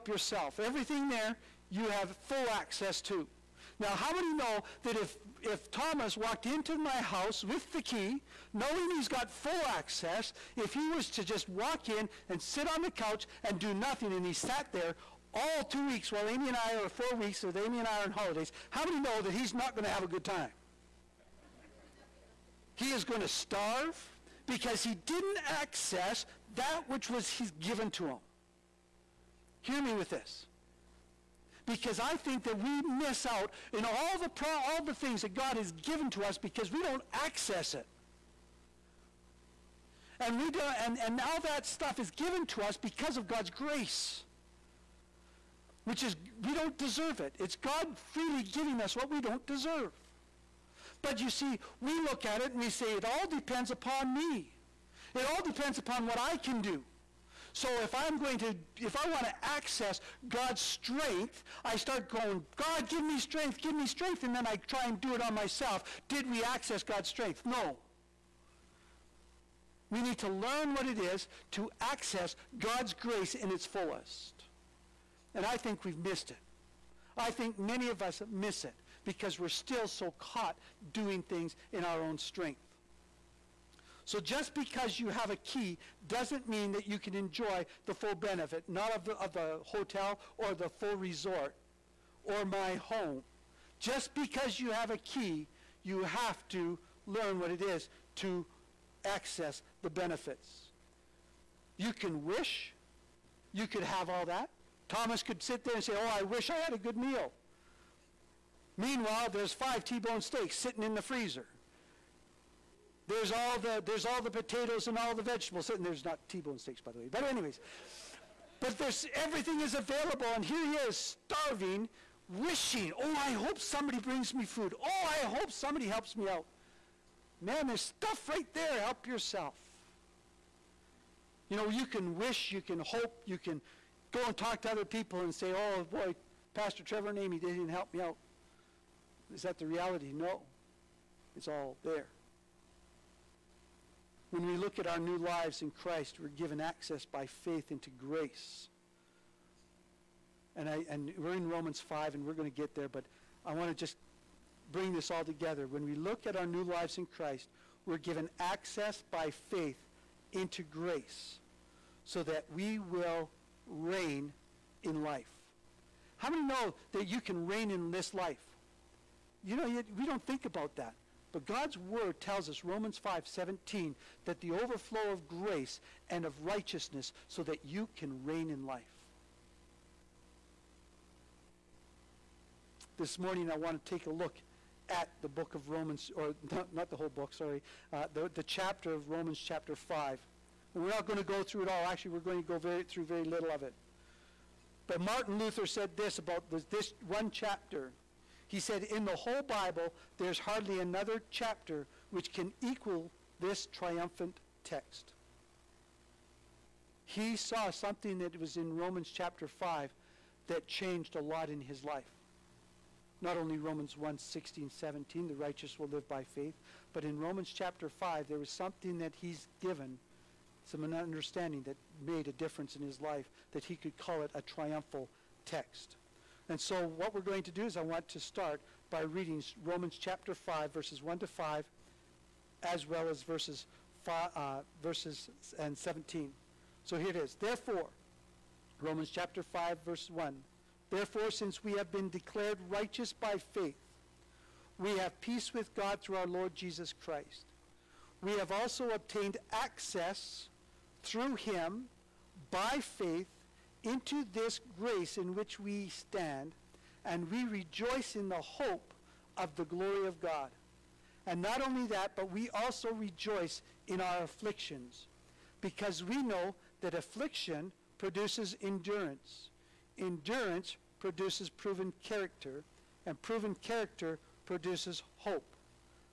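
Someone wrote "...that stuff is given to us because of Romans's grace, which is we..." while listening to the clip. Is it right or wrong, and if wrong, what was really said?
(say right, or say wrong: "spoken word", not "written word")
wrong: "God", not "Romans".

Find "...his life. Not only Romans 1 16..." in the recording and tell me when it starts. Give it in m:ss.
3:31.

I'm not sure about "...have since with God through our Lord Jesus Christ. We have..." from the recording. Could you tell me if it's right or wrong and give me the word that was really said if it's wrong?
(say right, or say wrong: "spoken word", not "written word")
wrong: "peace", not "since".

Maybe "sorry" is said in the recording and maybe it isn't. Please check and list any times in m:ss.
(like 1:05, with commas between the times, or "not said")
3:07.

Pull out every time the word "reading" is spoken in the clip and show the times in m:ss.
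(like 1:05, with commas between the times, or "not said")
3:49.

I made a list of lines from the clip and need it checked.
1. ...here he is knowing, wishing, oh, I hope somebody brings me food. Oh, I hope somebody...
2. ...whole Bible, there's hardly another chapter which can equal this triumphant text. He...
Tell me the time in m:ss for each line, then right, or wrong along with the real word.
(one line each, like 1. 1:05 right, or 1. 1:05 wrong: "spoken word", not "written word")
1. 2:00 wrong: "starving", not "knowing"
2. 3:19 right.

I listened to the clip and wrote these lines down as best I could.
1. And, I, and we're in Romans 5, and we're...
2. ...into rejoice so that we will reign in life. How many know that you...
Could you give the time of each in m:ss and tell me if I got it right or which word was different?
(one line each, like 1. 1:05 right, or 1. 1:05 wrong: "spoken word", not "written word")
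1. 2:30 right
2. 2:40 wrong: "grace", not "rejoice".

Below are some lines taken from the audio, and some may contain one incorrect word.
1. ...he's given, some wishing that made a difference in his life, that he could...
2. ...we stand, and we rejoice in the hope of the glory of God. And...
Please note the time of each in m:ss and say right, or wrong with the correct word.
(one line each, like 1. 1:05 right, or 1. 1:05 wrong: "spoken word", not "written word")
1. 3:39 wrong: "understanding", not "wishing"
2. 4:15 right.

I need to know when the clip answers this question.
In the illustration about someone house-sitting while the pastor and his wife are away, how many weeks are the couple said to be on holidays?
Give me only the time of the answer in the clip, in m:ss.
0:16.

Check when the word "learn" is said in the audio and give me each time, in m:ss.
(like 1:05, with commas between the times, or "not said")
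1:10, 1:37.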